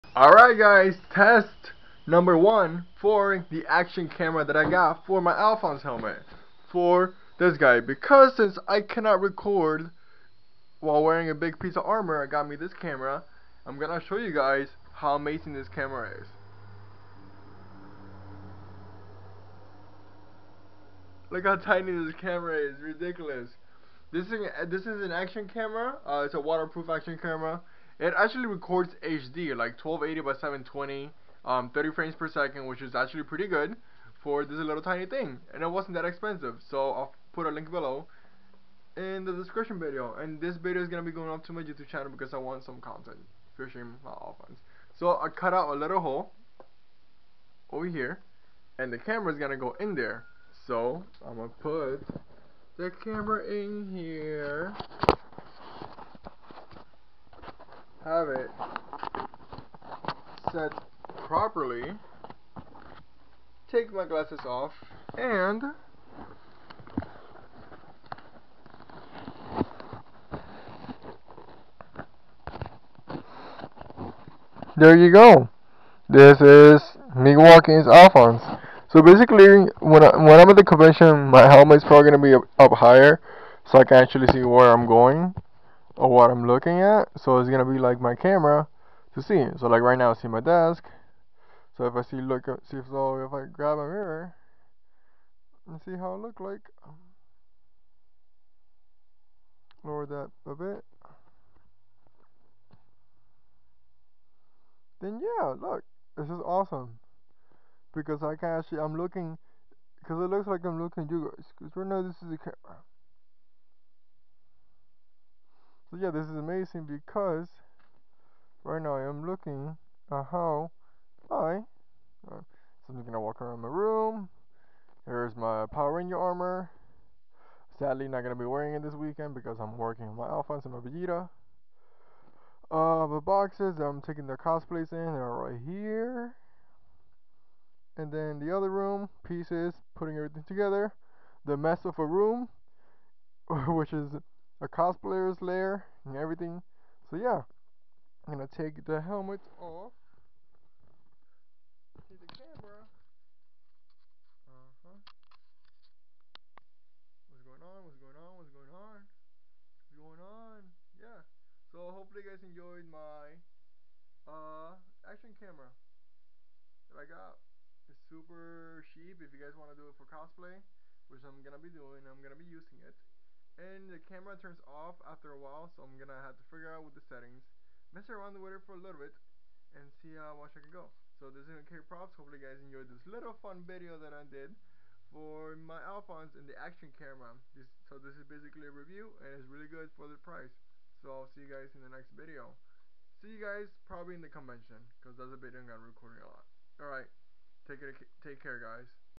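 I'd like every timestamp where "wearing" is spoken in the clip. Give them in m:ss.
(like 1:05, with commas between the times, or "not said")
0:11, 2:08.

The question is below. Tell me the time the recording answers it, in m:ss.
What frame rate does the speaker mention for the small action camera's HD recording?
0:31.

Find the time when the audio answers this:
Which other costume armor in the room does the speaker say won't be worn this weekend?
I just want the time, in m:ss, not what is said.
2:05.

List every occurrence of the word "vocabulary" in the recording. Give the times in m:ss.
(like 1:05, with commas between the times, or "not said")
not said.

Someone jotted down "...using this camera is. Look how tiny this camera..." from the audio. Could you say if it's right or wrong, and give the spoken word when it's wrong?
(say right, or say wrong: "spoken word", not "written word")
wrong: "amazing", not "using".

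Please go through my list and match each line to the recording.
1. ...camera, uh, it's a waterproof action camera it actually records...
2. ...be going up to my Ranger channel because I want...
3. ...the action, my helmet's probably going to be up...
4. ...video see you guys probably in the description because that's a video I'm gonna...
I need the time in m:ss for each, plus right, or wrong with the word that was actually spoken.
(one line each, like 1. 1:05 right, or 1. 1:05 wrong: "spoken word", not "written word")
1. 0:25 right
2. 0:41 wrong: "YouTube", not "Ranger"
3. 1:20 wrong: "convention", not "action"
4. 3:12 wrong: "convention", not "description".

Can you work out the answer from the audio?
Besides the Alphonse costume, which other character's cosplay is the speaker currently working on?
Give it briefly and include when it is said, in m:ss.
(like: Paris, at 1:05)
Vegeta, at 2:10.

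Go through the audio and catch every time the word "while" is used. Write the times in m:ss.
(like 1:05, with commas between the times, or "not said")
0:10, 2:55.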